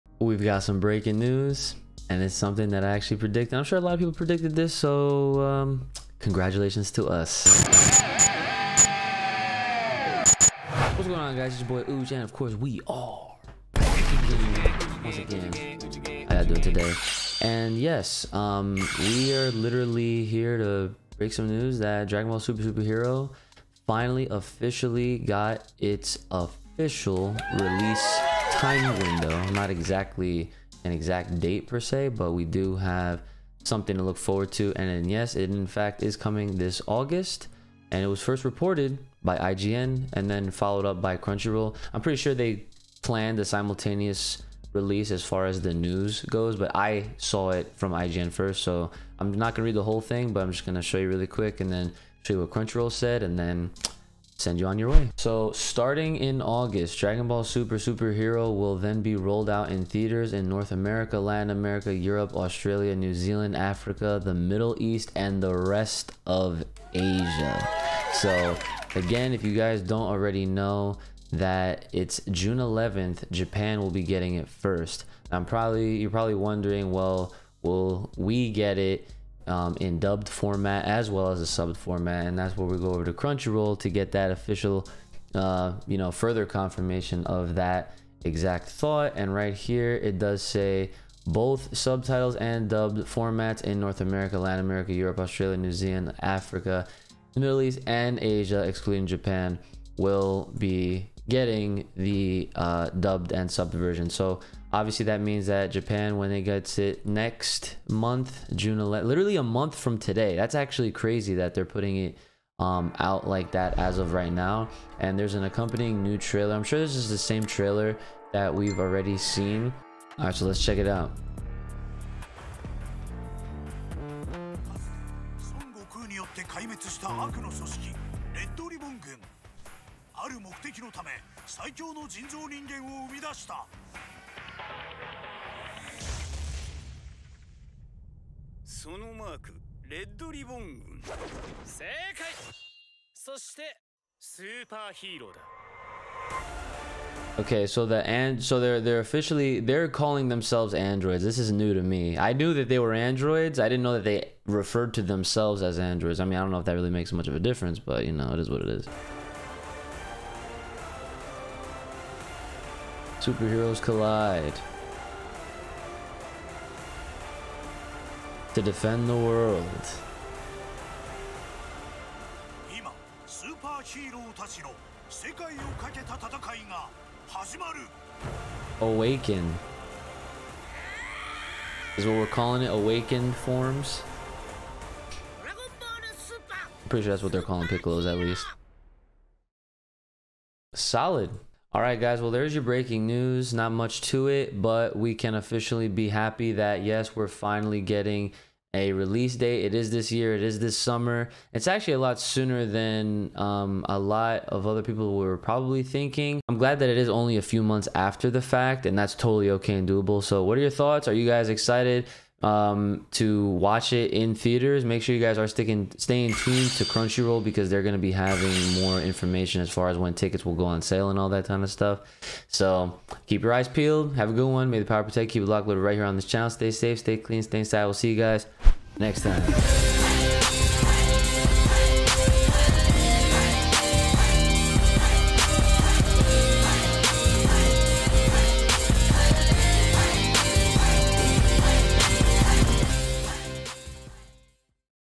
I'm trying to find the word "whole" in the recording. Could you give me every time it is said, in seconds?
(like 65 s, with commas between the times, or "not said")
49 s.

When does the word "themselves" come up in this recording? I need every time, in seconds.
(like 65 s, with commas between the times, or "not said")
150 s, 155 s.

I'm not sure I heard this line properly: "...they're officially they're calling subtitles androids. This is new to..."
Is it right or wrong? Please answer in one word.
wrong.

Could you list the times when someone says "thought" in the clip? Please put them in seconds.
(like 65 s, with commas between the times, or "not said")
88 s, 210 s.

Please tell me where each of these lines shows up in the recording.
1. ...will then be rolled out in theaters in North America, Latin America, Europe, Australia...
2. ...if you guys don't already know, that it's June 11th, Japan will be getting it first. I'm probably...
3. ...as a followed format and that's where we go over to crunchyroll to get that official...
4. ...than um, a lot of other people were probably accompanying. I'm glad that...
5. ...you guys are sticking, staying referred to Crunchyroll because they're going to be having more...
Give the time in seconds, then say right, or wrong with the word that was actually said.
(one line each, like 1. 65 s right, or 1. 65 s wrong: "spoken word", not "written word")
1. 58 s right
2. 69 s right
3. 81 s wrong: "subbed", not "followed"
4. 202 s wrong: "thinking", not "accompanying"
5. 215 s wrong: "tuned", not "referred".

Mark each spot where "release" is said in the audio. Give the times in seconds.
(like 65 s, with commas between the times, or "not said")
27 s, 44 s, 198 s.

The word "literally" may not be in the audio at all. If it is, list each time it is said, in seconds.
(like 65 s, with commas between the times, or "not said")
19 s, 109 s.